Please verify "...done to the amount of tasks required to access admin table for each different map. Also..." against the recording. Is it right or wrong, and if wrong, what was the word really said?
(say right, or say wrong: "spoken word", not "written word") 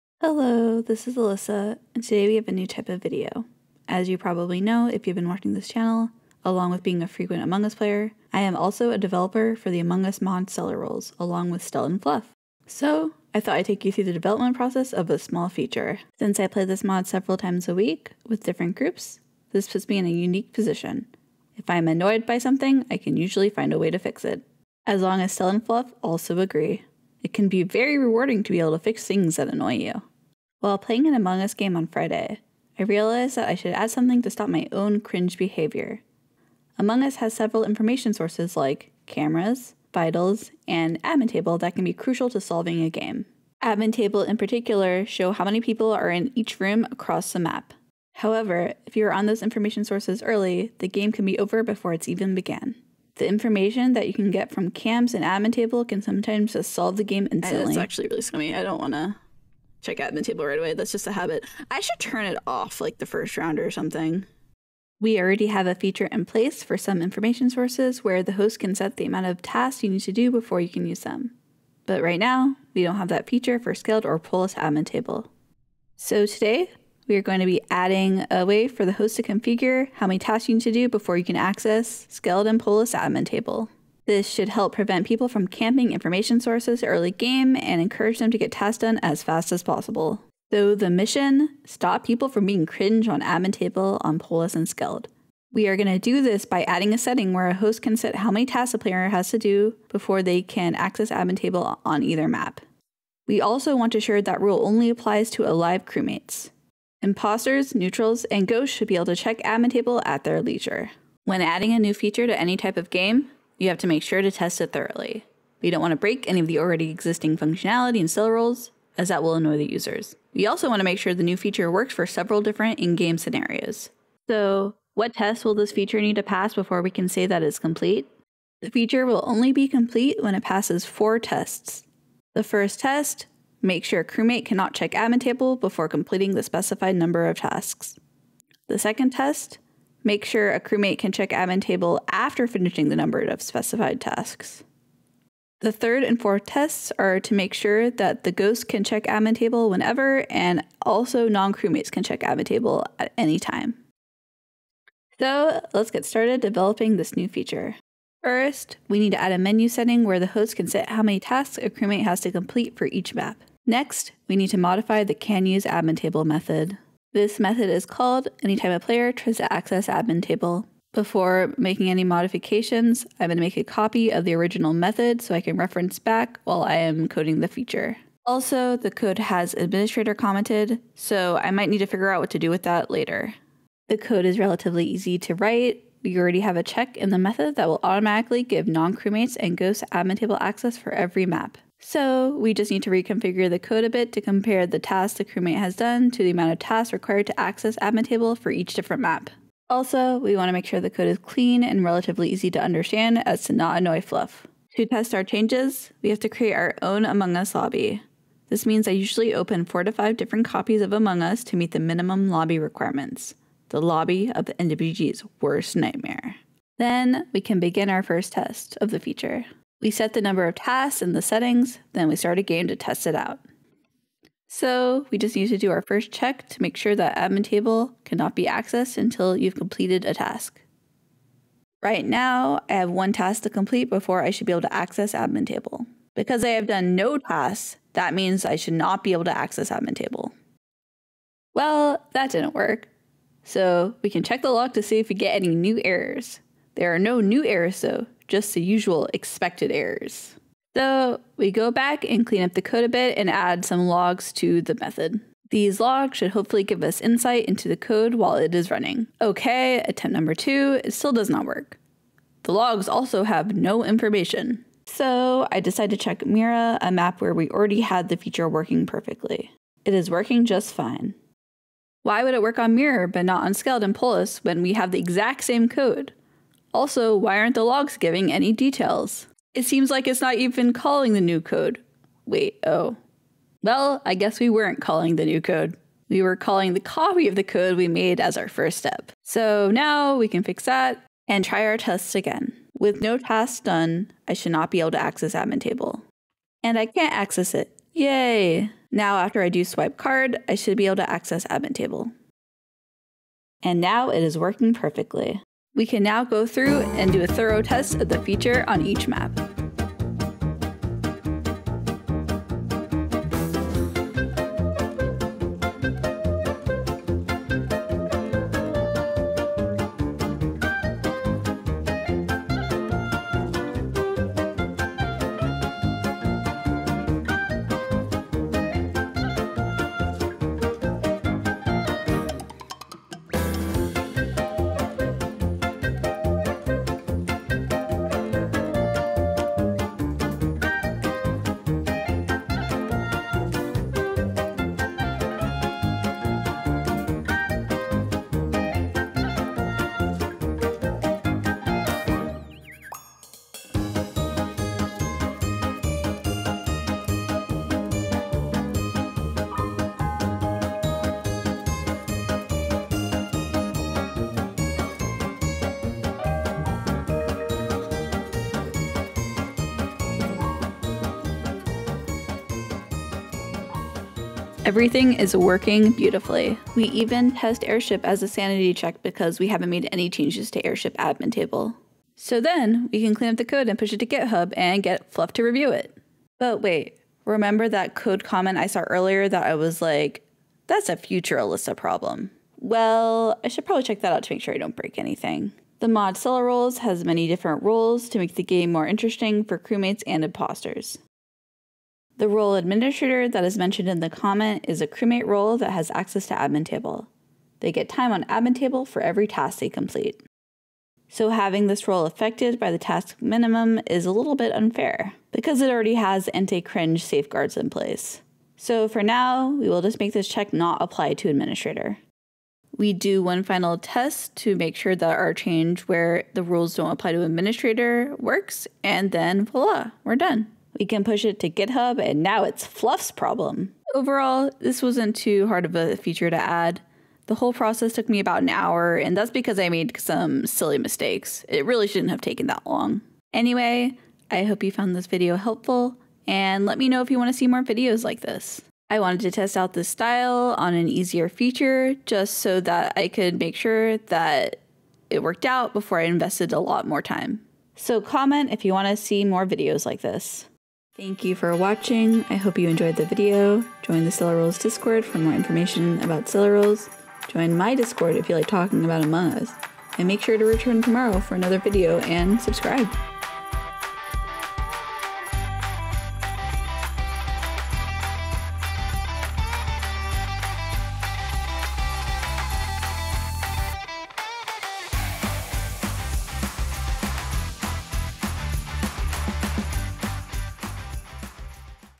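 right.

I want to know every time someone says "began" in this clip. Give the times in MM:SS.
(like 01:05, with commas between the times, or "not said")
00:52.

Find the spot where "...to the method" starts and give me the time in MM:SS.
04:14.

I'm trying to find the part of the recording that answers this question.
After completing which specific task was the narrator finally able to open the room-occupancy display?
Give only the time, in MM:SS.
04:59.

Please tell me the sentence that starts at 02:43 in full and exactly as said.
Next, we need to modify the can use admin table method.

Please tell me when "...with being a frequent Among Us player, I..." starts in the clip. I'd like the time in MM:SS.
00:06.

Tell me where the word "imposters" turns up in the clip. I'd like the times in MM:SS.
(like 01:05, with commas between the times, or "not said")
01:47, 06:40.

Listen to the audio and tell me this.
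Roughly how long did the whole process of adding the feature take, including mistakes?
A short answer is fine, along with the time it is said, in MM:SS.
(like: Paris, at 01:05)
About an hour, at 07:18.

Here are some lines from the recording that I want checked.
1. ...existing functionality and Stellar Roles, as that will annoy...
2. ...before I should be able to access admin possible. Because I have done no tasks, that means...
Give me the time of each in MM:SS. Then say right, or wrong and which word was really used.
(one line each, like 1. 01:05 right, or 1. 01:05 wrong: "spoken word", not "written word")
1. 01:56 right
2. 03:53 wrong: "table", not "possible".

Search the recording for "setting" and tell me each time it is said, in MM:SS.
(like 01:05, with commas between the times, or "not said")
01:36, 02:39, 03:41.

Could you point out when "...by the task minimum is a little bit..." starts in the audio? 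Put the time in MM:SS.
06:52.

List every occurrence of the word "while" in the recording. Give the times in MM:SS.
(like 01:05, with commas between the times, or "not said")
00:30, 02:56, 04:18.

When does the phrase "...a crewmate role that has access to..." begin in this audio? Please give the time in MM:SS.
06:44.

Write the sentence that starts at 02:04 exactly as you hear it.
So what tests will this feature need to pass before we can say that it's complete?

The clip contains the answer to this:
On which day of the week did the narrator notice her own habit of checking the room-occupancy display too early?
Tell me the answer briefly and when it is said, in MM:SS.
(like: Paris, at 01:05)
Friday, at 00:31.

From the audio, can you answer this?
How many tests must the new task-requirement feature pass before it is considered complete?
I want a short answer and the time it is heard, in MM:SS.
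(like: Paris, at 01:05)
4, at 02:10.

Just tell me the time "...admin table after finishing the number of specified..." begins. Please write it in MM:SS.
02:21.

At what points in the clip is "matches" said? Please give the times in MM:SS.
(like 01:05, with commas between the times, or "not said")
not said.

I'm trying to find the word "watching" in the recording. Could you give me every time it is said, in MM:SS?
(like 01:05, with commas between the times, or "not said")
00:05, 07:41.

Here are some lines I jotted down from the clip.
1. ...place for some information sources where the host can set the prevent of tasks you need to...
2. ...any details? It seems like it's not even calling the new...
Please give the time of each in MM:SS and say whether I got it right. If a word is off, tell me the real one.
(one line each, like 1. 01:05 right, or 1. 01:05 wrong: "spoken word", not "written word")
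1. 01:06 wrong: "amount", not "prevent"
2. 04:38 right.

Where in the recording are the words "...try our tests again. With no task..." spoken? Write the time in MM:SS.
04:51.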